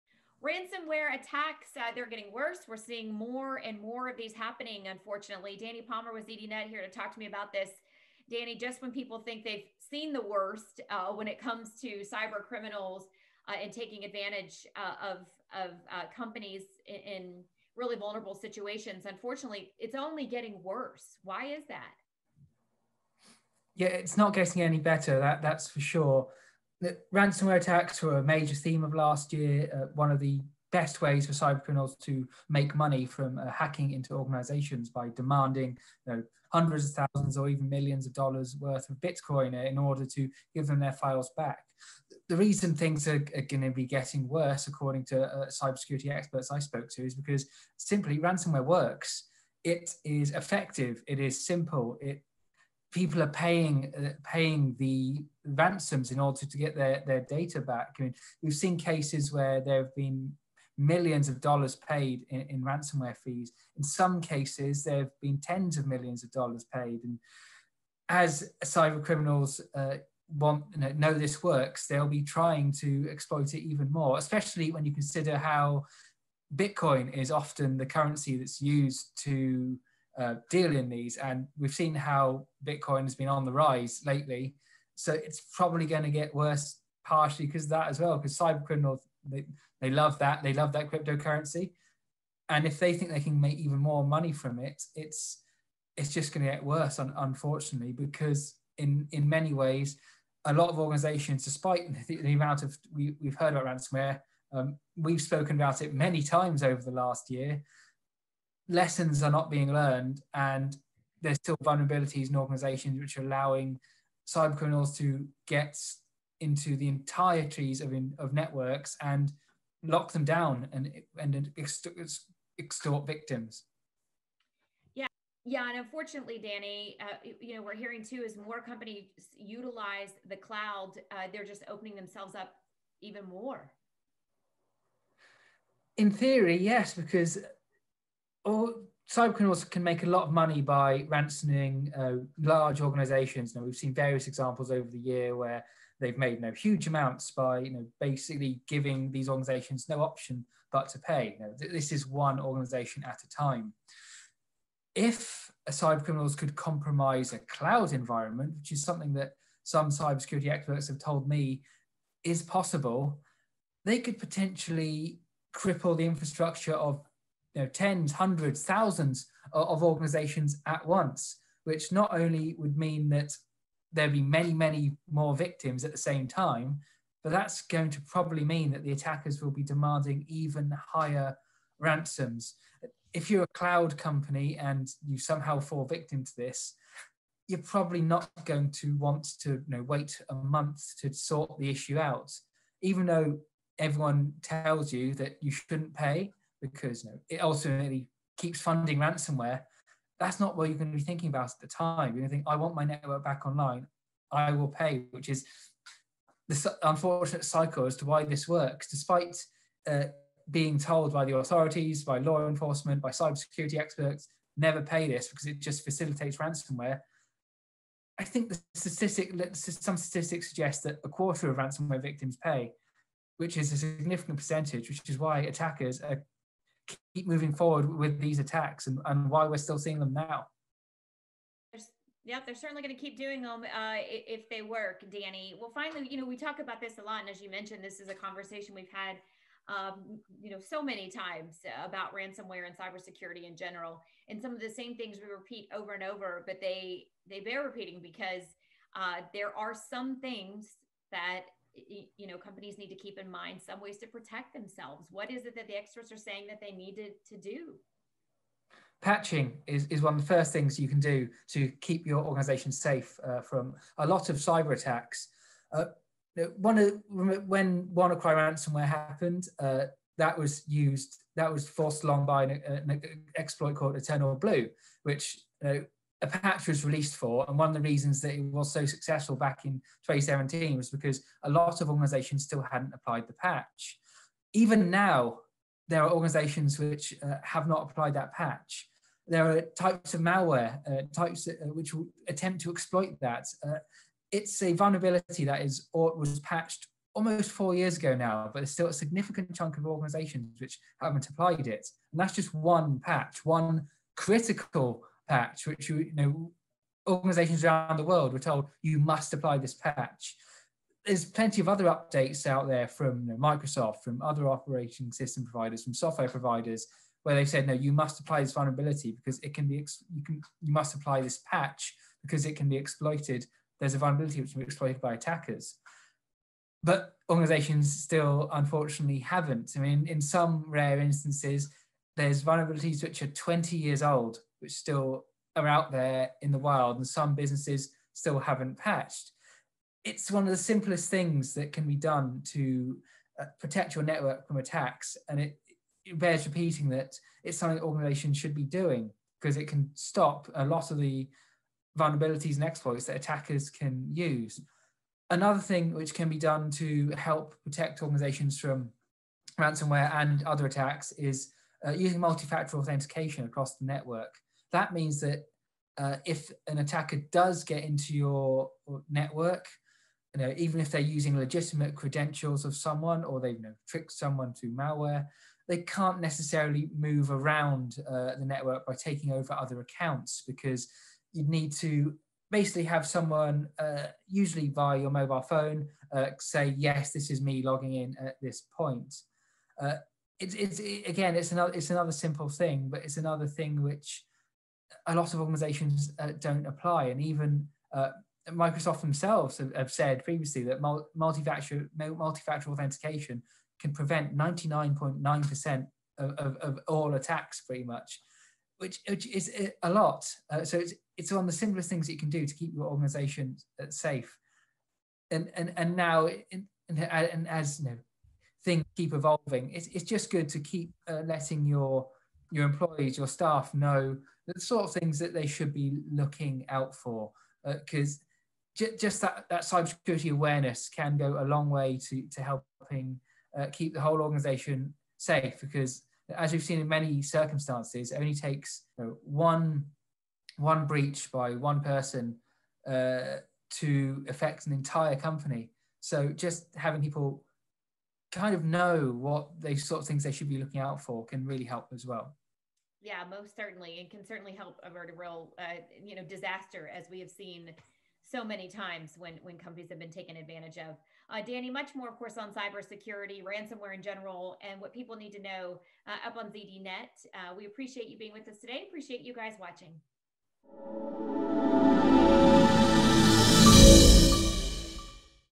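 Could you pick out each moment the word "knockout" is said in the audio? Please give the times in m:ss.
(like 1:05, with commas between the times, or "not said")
not said.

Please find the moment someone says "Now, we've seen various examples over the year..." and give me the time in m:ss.
2:23.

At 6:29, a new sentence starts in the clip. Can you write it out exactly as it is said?
Uh, it's, it's, again, it's another, it's another simple thing, but it's another thing which a lot of organizations uh, don't apply.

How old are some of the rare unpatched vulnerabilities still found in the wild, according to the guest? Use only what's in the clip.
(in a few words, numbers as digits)
20 years.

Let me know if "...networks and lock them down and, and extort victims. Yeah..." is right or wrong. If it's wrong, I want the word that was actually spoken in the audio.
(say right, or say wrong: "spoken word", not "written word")
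right.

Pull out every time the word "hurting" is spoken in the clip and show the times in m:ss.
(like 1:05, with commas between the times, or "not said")
not said.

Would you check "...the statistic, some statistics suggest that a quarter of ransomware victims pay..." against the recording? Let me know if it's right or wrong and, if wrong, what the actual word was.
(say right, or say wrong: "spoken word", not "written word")
right.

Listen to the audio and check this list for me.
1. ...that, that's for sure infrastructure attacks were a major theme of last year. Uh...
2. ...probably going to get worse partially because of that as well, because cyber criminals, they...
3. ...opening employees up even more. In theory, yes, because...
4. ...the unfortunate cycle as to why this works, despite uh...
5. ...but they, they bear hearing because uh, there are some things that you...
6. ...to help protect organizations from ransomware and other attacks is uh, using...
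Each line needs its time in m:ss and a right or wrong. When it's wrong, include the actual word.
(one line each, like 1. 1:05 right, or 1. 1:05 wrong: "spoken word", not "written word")
1. 0:25 wrong: "ransomware", not "infrastructure"
2. 1:25 right
3. 2:11 wrong: "themselves", not "employees"
4. 3:26 right
5. 4:06 wrong: "repeating", not "hearing"
6. 5:56 right.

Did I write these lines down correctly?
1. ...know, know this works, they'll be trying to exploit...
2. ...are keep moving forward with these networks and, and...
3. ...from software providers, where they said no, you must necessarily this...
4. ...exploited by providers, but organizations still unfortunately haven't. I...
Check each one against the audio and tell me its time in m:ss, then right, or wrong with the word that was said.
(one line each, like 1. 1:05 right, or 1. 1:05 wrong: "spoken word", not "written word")
1. 1:10 right
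2. 3:46 wrong: "attacks", not "networks"
3. 5:15 wrong: "apply", not "necessarily"
4. 5:24 wrong: "attackers", not "providers".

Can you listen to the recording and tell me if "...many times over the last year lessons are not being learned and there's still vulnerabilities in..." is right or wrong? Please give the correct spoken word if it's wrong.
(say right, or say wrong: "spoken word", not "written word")
right.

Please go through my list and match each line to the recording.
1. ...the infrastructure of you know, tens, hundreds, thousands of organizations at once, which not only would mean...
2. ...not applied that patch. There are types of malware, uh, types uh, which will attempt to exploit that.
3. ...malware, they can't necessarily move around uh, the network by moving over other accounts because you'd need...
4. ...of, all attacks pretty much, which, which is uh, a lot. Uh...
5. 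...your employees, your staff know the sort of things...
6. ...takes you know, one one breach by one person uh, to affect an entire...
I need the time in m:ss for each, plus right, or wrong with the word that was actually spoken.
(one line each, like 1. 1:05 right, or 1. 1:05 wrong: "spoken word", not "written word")
1. 2:45 right
2. 4:47 right
3. 6:14 wrong: "taking", not "moving"
4. 6:46 right
5. 7:02 right
6. 7:18 right.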